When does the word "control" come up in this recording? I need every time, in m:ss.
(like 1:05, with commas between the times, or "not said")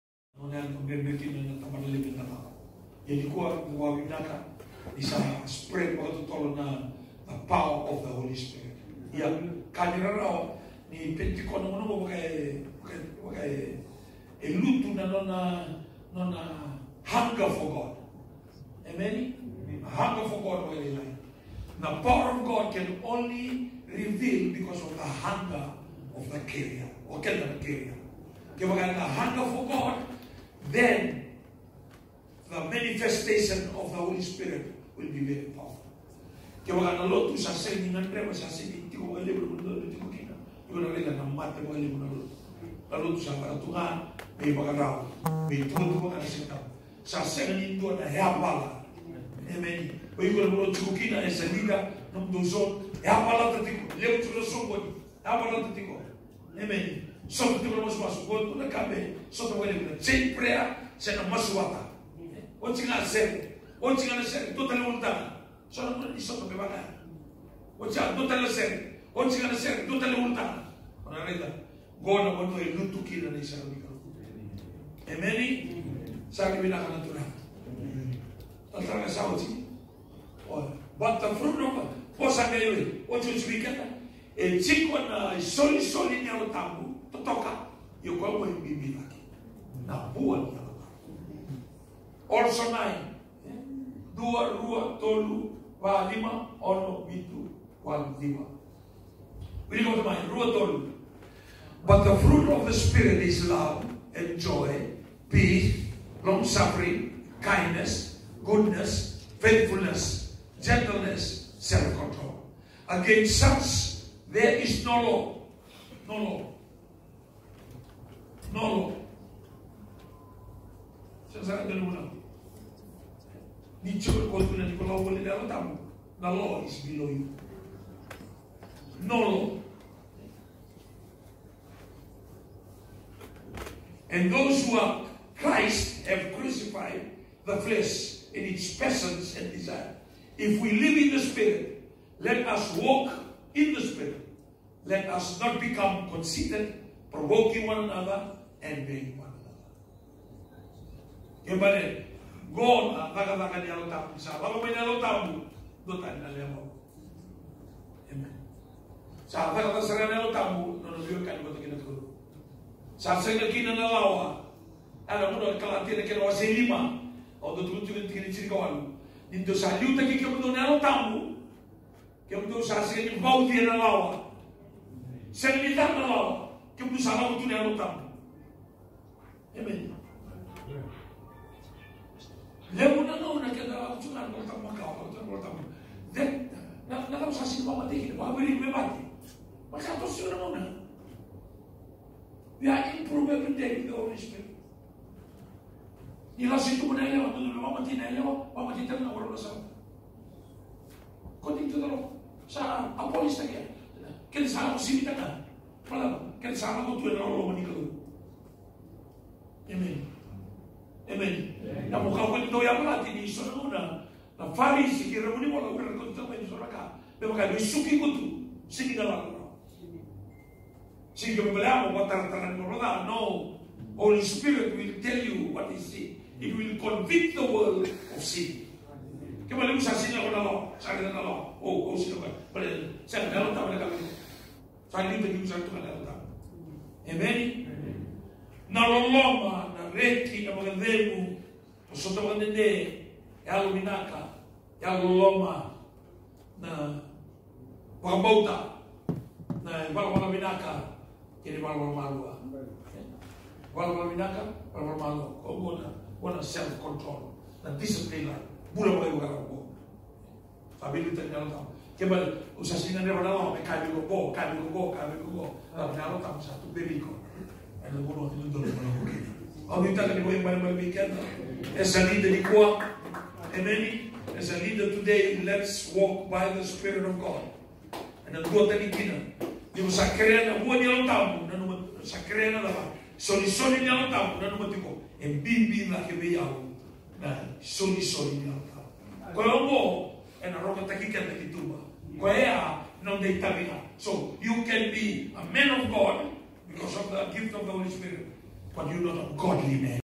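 1:51, 4:16.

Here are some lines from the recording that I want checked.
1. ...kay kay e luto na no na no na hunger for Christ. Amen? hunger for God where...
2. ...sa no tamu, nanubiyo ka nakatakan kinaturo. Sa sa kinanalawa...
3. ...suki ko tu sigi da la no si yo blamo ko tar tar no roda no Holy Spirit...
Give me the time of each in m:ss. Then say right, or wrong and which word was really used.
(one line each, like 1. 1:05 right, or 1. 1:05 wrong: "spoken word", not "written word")
1. 0:12 wrong: "God", not "Christ"
2. 2:39 wrong: "naman", not "nakatakan"
3. 3:37 right.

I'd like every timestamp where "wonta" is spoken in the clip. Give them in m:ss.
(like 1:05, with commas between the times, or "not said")
1:04, 1:10.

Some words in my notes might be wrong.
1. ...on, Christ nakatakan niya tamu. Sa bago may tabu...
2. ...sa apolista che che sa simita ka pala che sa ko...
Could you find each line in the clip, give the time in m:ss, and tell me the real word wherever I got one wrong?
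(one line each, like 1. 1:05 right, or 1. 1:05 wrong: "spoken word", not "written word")
1. 2:32 wrong: "God", not "Christ"
2. 3:22 right.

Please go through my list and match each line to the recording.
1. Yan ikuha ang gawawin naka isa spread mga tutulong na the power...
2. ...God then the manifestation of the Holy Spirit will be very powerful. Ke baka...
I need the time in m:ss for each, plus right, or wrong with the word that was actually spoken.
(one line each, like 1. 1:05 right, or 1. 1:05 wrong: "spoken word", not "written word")
1. 0:03 right
2. 0:29 right.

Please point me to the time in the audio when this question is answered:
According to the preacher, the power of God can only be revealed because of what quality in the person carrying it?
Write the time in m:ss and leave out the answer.
0:25.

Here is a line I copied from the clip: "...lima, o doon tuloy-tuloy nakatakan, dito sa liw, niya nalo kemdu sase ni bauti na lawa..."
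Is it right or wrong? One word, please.
wrong.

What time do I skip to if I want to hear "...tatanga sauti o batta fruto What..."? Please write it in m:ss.
1:18.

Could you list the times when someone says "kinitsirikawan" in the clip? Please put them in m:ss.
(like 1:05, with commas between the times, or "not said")
2:48.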